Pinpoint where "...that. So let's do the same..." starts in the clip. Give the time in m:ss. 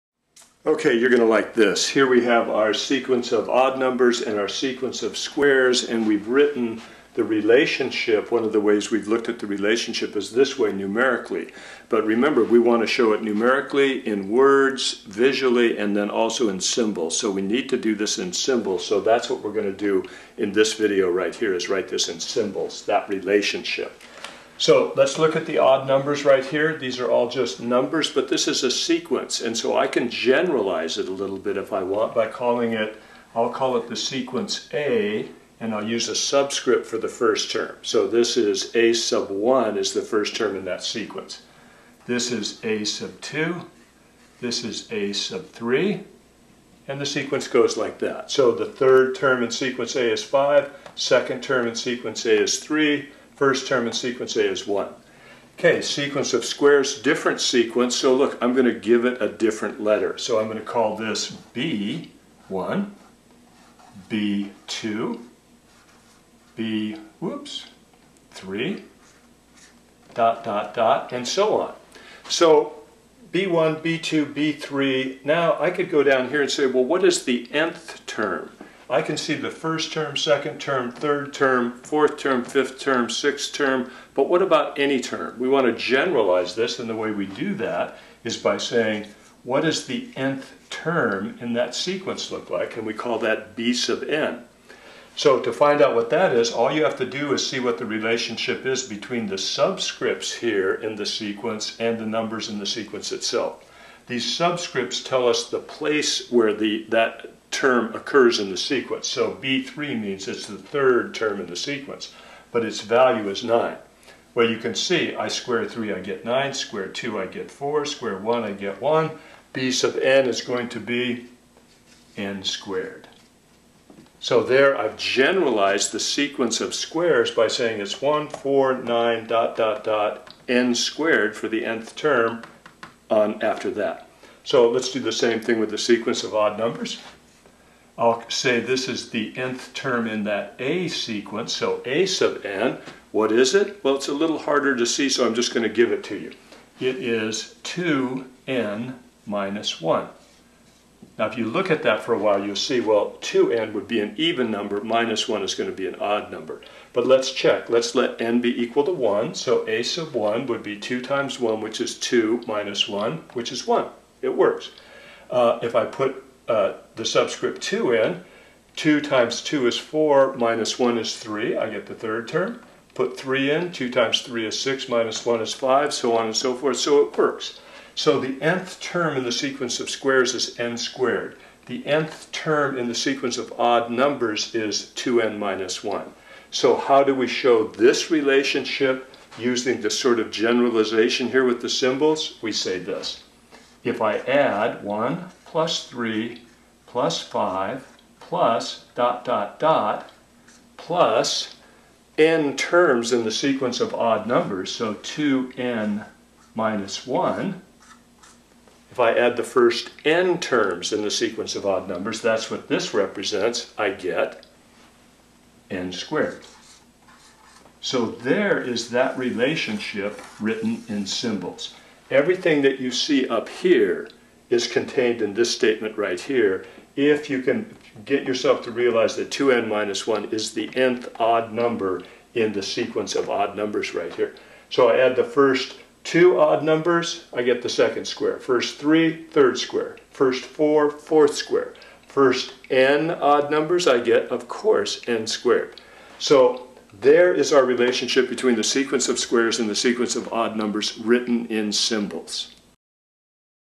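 2:13.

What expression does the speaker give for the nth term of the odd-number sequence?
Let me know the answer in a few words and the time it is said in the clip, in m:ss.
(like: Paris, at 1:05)
2n minus 1, at 2:26.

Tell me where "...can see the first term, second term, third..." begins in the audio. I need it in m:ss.
1:19.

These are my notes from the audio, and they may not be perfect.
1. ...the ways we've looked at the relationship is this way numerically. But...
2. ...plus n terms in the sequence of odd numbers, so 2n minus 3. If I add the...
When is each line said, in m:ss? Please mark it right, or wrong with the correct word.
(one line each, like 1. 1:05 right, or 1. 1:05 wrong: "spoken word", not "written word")
1. 0:08 right
2. 3:20 wrong: "1", not "3".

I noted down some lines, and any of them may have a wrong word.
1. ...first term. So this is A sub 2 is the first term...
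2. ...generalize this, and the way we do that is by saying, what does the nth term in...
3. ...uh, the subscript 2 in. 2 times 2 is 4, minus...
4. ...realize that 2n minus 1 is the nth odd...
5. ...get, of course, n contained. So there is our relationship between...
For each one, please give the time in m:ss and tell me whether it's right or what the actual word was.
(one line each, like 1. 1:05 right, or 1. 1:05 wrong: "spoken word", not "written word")
1. 0:37 wrong: "1", not "2"
2. 1:25 right
3. 2:46 right
4. 3:48 right
5. 4:04 wrong: "squared", not "contained".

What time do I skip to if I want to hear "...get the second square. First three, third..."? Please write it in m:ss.
3:57.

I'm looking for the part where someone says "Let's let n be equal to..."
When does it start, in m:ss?
2:37.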